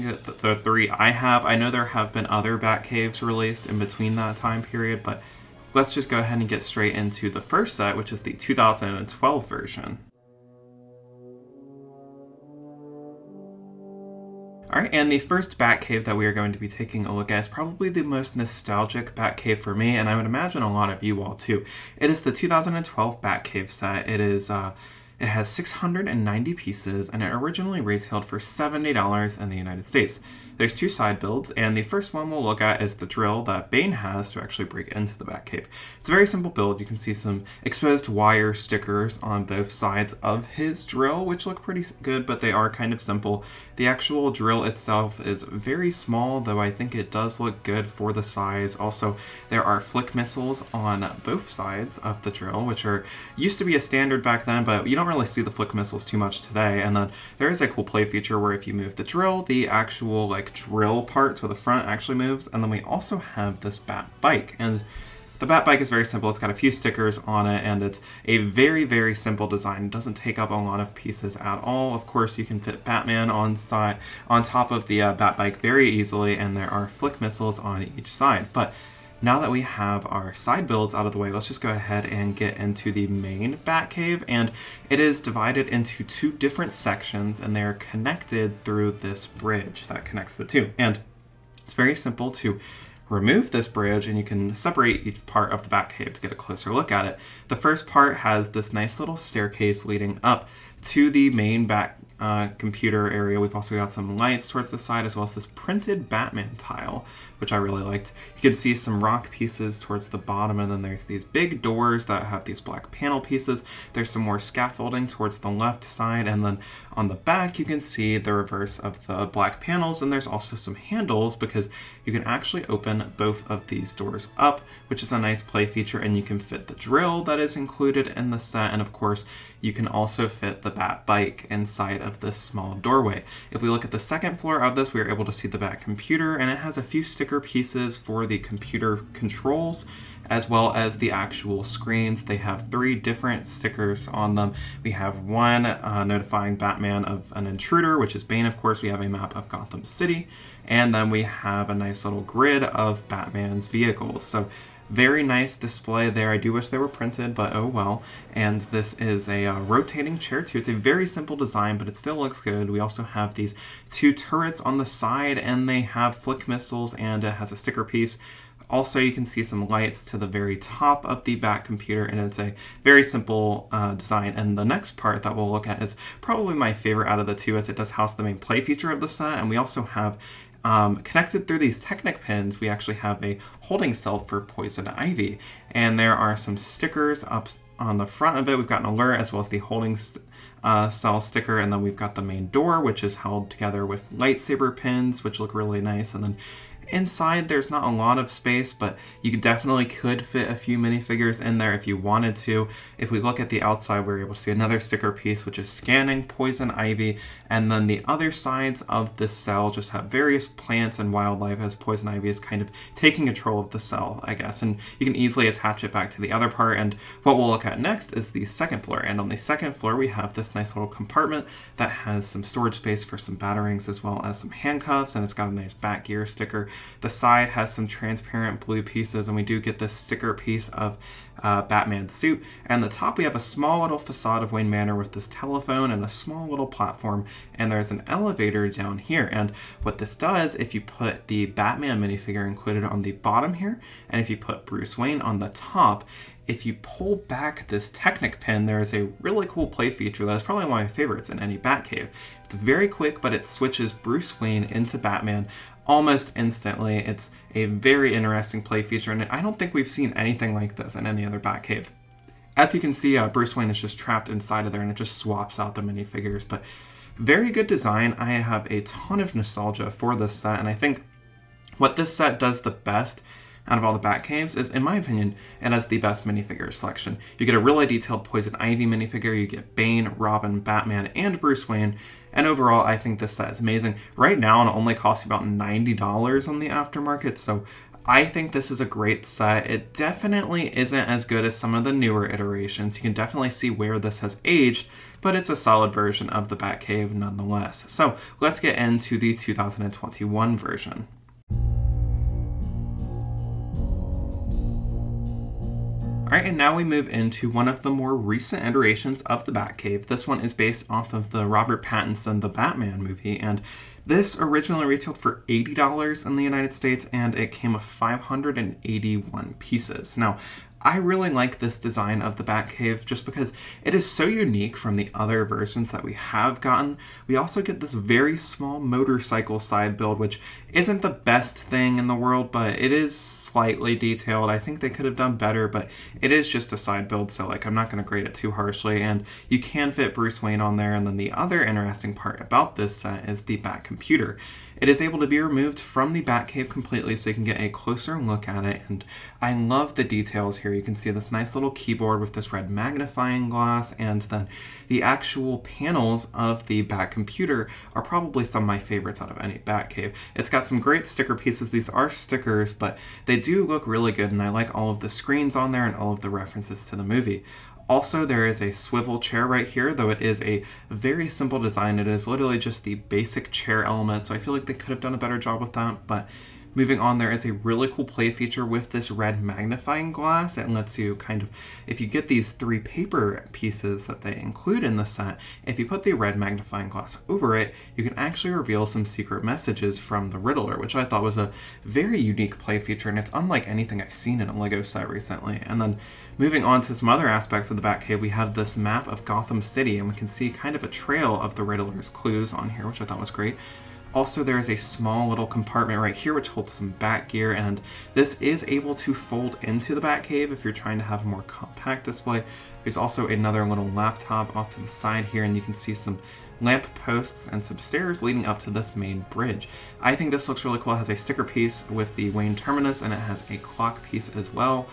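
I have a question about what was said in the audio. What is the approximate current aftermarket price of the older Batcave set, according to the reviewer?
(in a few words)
$90.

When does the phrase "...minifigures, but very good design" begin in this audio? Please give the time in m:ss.
4:25.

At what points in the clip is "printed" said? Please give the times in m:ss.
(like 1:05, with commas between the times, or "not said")
1:45, 2:36.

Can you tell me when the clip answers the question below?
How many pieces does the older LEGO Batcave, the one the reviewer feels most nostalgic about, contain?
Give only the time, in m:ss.
0:25.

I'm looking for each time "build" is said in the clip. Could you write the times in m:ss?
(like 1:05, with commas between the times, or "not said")
0:31, 0:36, 1:20, 5:29, 5:37.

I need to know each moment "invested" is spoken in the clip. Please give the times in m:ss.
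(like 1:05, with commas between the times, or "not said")
not said.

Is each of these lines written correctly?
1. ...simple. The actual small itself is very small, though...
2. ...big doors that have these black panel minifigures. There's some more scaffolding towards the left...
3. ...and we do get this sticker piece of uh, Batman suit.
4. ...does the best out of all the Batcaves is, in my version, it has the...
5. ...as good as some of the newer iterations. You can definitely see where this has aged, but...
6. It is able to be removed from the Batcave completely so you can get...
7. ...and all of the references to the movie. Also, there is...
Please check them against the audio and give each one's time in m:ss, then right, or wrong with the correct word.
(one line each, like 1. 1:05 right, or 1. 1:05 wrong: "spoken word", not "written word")
1. 0:43 wrong: "drill", not "small"
2. 1:51 wrong: "pieces", not "minifigures"
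3. 3:49 right
4. 4:32 wrong: "opinion", not "version"
5. 4:51 right
6. 5:44 right
7. 6:05 right.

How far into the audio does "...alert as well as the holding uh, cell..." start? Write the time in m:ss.
3:08.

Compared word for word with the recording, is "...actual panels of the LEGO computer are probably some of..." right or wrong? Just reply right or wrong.
wrong.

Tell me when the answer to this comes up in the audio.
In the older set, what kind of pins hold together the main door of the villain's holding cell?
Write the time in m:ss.
3:14.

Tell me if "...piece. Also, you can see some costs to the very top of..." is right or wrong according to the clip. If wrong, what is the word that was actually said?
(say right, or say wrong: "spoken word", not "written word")
wrong: "lights", not "costs".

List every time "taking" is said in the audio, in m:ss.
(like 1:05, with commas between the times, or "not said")
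0:16, 3:32.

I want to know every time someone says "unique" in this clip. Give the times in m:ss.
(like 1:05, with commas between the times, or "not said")
5:24, 6:32.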